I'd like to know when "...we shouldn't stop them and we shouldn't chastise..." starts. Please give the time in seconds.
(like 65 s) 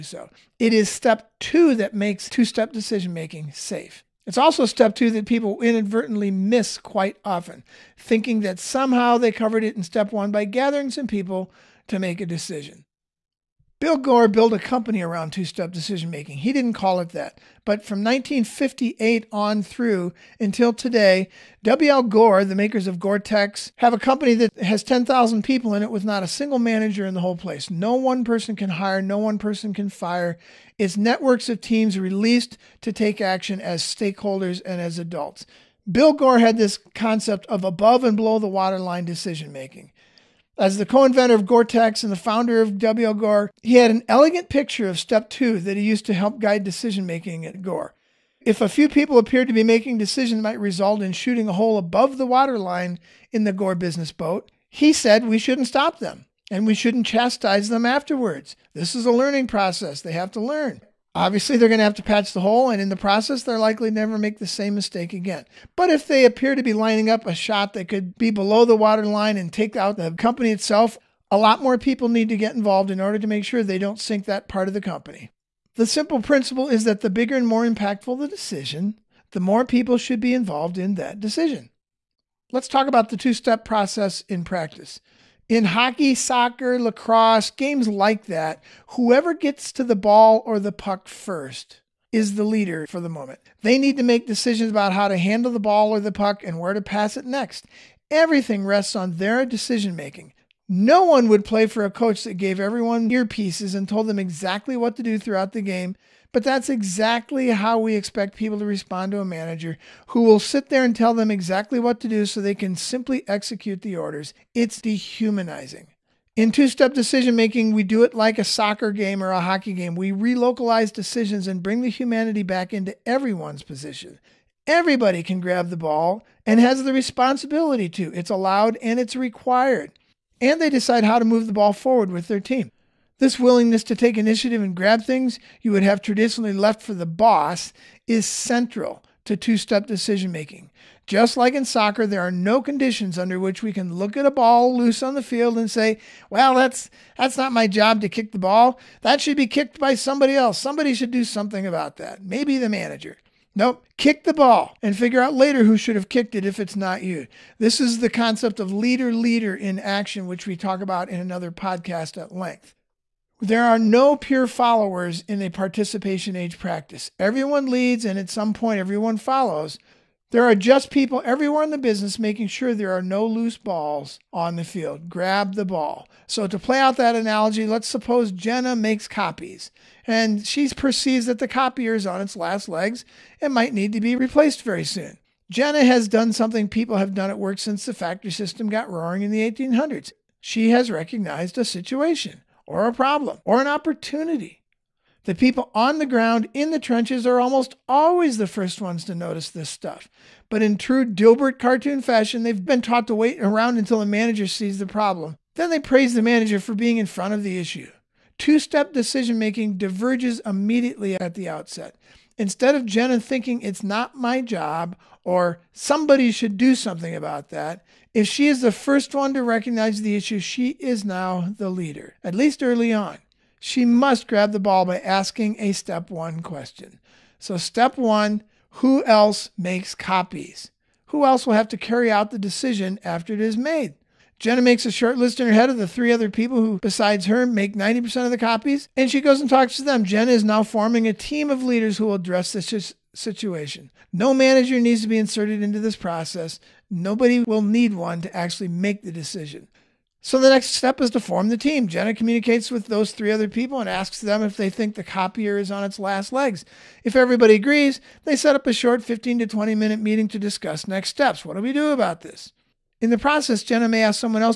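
55 s.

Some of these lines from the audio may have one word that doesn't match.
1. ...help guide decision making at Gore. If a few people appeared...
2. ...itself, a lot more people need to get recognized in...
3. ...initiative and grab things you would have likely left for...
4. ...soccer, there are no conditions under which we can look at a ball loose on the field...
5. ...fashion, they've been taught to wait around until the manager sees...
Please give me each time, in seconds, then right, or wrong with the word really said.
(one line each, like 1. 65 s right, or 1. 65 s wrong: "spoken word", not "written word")
1. 46 s right
2. 70 s wrong: "involved", not "recognized"
3. 134 s wrong: "traditionally", not "likely"
4. 141 s right
5. 202 s right.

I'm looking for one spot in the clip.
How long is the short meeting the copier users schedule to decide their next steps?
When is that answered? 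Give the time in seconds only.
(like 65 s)
259 s.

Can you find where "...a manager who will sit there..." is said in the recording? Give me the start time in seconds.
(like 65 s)
109 s.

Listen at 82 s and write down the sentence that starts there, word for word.
Let's talk about the two step process in practice.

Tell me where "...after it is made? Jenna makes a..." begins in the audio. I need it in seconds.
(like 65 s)
233 s.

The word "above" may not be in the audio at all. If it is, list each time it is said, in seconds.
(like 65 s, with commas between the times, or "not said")
37 s, 51 s.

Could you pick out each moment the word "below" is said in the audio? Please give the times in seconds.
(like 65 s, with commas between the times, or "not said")
38 s, 68 s.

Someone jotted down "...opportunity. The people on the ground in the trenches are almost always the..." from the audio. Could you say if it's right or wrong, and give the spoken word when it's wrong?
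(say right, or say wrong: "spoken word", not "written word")
right.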